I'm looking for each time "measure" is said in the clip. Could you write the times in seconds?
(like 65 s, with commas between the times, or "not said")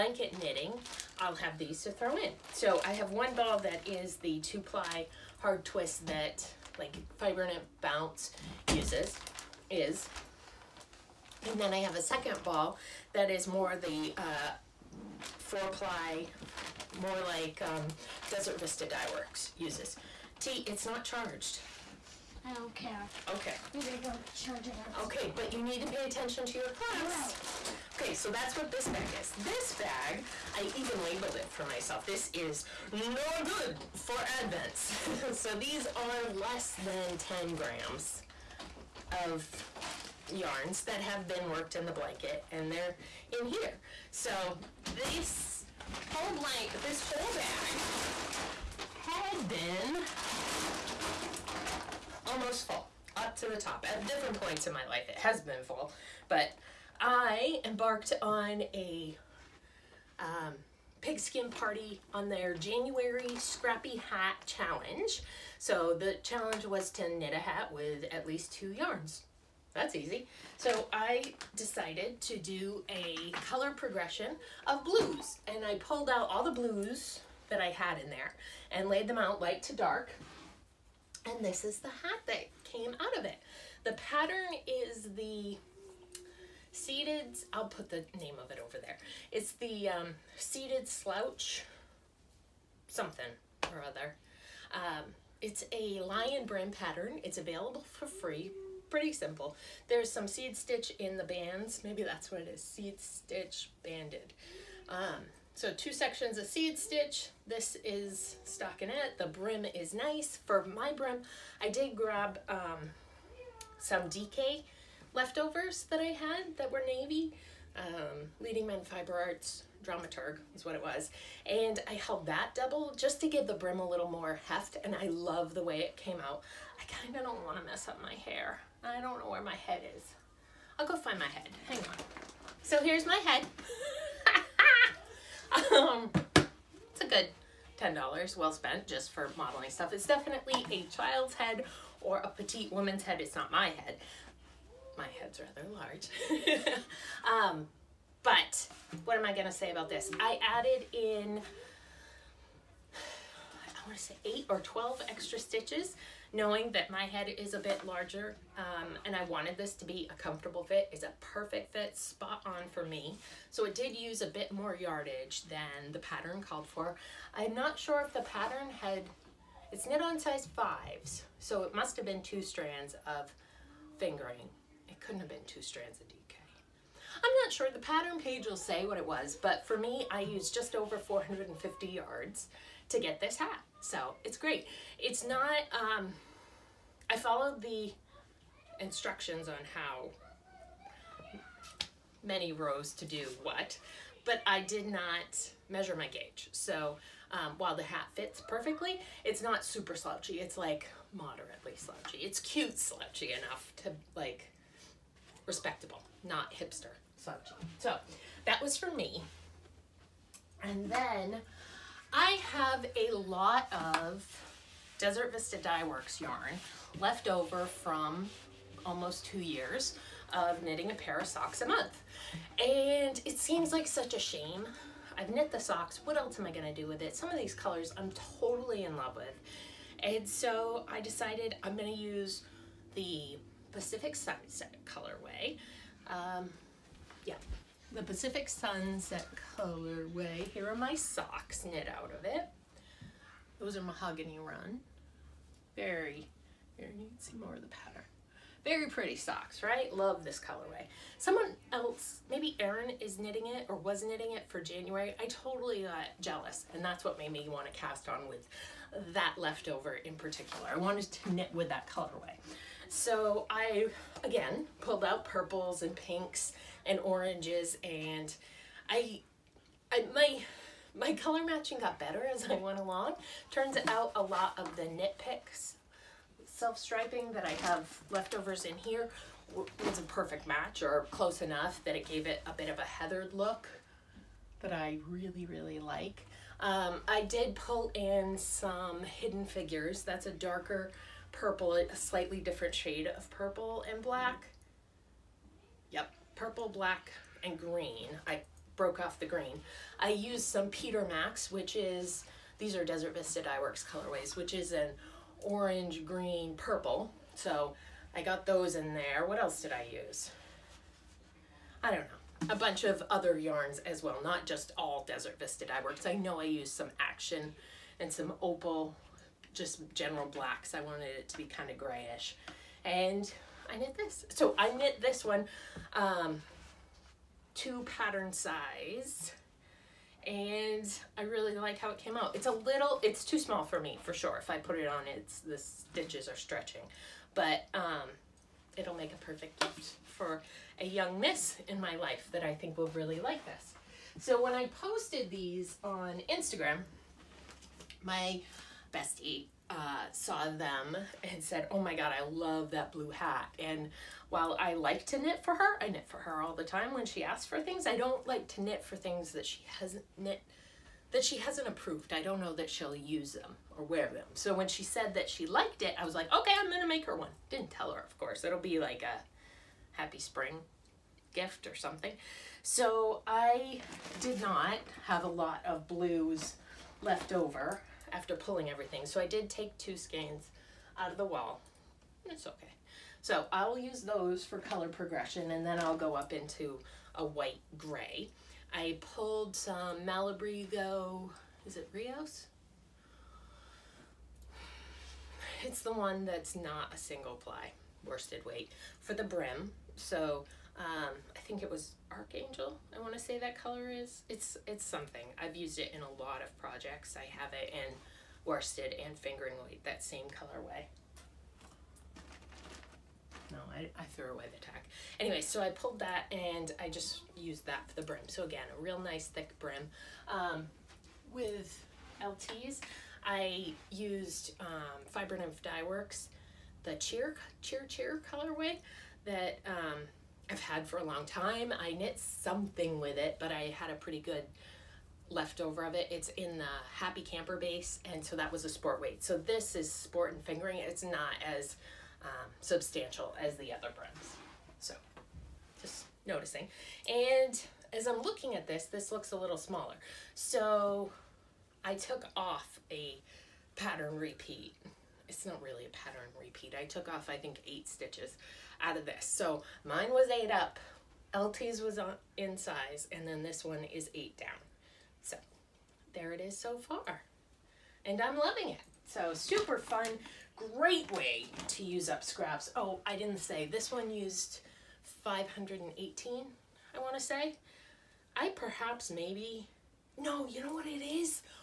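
195 s.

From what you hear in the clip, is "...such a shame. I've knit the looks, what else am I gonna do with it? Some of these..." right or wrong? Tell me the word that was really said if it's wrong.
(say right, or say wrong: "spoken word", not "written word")
wrong: "socks", not "looks".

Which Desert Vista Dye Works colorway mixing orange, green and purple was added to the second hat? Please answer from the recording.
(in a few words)
Peter Max.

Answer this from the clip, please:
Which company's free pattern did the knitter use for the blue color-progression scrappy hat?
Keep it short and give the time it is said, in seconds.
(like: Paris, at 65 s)
Lion Brand, at 96 s.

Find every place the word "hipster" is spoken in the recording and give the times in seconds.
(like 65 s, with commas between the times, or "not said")
206 s.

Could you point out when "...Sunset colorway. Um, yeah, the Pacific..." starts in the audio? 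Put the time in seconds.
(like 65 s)
234 s.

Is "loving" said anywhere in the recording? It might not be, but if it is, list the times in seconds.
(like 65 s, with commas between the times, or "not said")
468 s.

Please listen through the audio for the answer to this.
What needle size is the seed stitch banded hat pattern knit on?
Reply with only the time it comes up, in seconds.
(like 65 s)
170 s.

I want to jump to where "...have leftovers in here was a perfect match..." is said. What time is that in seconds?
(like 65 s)
277 s.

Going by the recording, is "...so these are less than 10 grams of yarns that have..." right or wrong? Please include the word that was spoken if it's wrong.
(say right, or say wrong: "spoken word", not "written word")
right.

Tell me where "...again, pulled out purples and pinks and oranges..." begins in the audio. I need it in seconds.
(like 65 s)
264 s.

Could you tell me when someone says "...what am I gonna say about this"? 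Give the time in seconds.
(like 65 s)
149 s.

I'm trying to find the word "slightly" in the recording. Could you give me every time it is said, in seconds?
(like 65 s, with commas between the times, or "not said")
291 s.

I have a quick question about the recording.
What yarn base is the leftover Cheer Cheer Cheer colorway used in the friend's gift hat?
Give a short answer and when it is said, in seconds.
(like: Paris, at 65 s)
Happy Camper, at 436 s.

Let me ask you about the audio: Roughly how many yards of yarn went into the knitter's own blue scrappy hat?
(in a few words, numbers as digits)
450 yards.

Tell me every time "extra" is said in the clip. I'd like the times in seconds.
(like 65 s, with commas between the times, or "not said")
155 s.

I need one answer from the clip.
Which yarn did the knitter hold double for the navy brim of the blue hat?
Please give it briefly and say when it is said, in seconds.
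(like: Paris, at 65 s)
Leading Men Fiber Arts Dramaturg, at 118 s.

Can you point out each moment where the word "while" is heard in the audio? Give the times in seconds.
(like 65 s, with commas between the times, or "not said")
197 s, 354 s.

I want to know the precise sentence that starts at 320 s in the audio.
I wanted it to be kind of grayish.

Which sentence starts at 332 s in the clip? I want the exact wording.
It's a little, it's too small for me for sure.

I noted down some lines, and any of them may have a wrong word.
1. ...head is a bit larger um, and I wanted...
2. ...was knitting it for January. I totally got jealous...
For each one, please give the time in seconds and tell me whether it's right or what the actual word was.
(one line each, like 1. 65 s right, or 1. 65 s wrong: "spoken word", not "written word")
1. 157 s right
2. 253 s right.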